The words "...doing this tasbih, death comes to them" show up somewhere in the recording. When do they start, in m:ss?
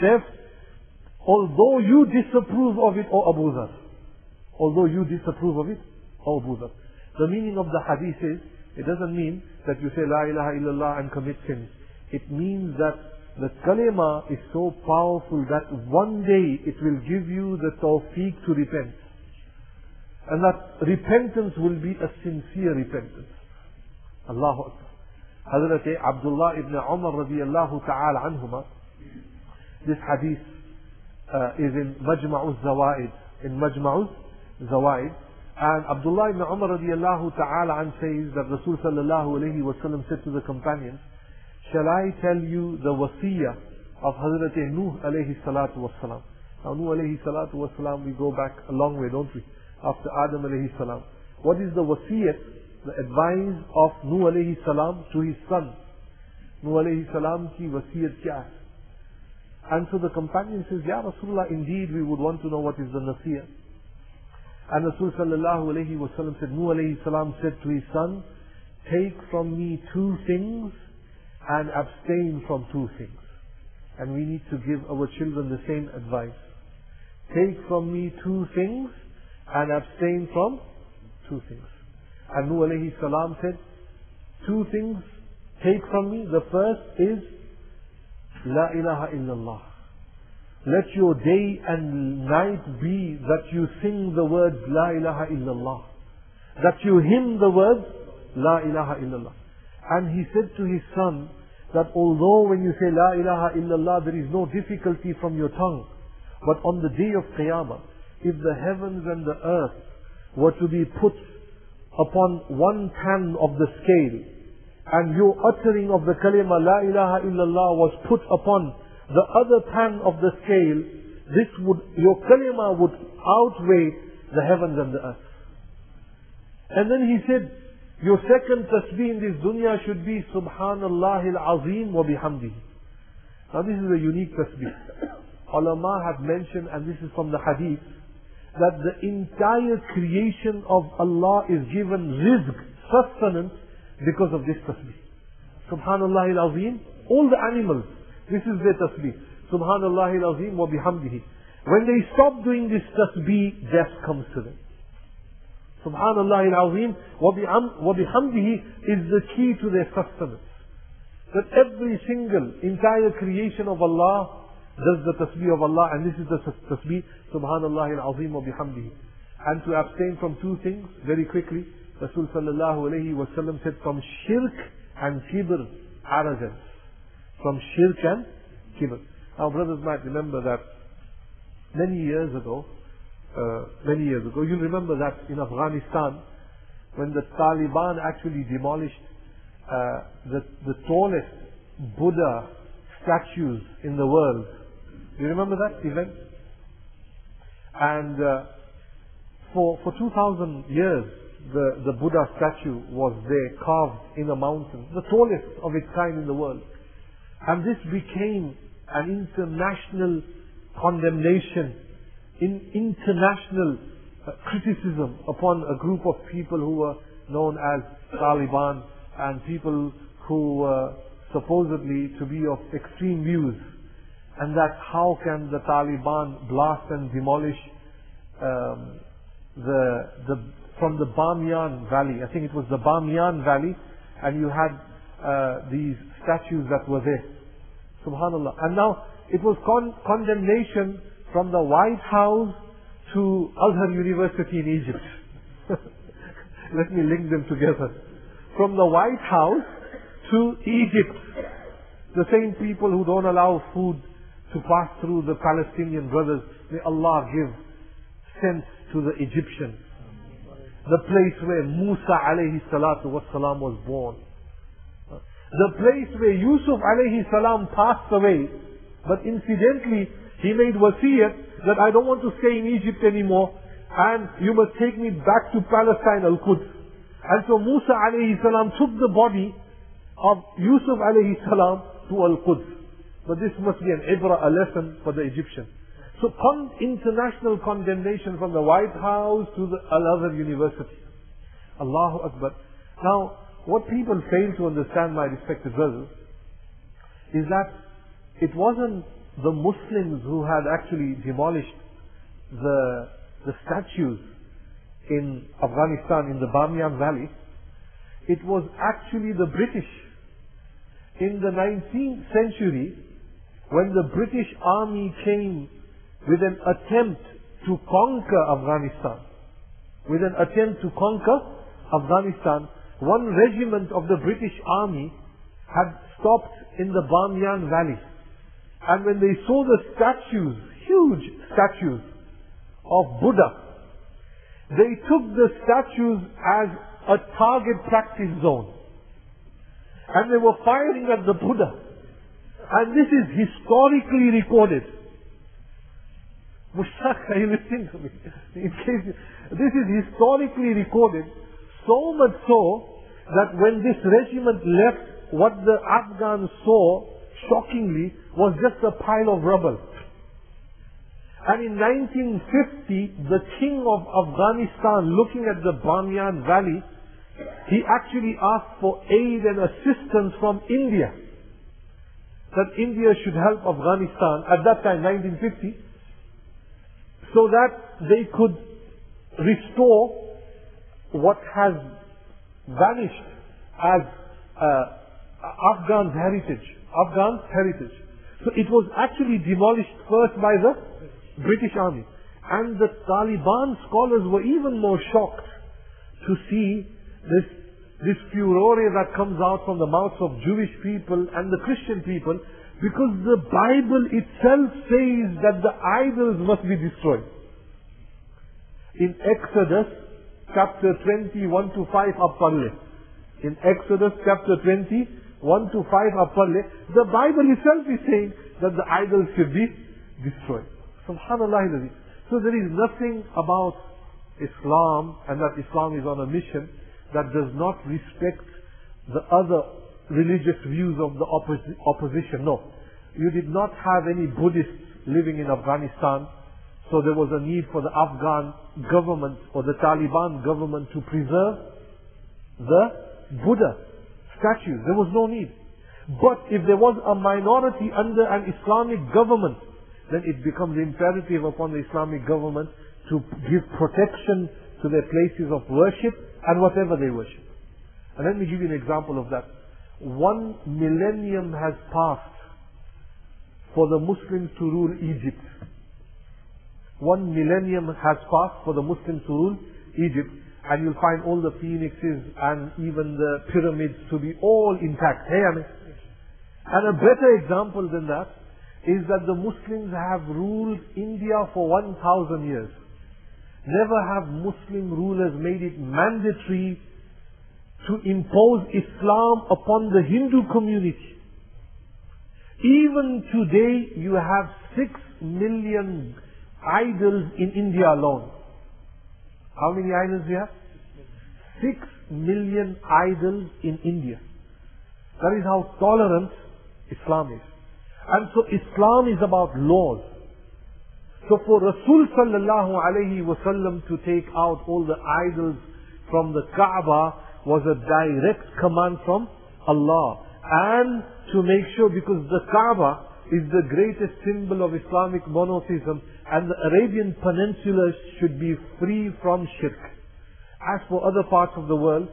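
2:32.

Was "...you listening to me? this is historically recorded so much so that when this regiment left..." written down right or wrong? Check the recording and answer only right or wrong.
right.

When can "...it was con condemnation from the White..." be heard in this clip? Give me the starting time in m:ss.
3:59.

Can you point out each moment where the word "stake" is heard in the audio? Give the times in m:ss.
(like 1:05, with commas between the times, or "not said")
not said.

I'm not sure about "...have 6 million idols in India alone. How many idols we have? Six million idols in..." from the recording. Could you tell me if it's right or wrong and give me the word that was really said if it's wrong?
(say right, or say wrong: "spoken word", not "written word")
right.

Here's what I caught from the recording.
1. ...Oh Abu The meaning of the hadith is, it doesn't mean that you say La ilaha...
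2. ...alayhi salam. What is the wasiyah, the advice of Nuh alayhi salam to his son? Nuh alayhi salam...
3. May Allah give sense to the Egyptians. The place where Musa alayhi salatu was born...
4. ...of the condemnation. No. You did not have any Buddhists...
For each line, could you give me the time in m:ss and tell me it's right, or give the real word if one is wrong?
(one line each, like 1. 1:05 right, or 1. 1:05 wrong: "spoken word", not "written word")
1. 0:06 right
2. 0:50 right
3. 4:16 right
4. 7:11 wrong: "opposition", not "condemnation".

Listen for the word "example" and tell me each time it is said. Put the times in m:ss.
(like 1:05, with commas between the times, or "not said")
7:38, 7:57.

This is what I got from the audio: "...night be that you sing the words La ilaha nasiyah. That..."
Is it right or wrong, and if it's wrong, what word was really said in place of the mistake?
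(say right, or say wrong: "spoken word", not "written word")
wrong: "illallah", not "nasiyah".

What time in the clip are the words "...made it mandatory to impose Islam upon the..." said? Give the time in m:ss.
8:05.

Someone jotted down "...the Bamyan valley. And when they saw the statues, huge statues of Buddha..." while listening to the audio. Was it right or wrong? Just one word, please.
right.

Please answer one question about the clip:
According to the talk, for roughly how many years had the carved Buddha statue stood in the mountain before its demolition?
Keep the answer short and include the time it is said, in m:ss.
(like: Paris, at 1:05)
2,000, at 3:19.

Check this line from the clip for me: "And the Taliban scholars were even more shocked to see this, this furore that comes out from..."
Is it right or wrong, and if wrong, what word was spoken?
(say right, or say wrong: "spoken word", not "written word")
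right.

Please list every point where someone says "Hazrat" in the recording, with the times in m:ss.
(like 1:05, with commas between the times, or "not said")
0:25, 0:44.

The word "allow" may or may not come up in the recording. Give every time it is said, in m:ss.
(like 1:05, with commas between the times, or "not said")
4:13.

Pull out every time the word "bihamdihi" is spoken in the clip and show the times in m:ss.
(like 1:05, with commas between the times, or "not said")
2:12, 2:30, 2:37, 2:48.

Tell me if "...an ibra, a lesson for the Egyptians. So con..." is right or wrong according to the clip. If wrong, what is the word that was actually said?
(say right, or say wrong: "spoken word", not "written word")
right.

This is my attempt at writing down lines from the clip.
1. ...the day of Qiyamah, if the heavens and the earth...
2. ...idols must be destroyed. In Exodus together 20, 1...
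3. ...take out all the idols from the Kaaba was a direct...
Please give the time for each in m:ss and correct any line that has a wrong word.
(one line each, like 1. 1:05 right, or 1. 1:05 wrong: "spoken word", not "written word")
1. 1:46 right
2. 6:45 wrong: "chapter", not "together"
3. 8:34 right.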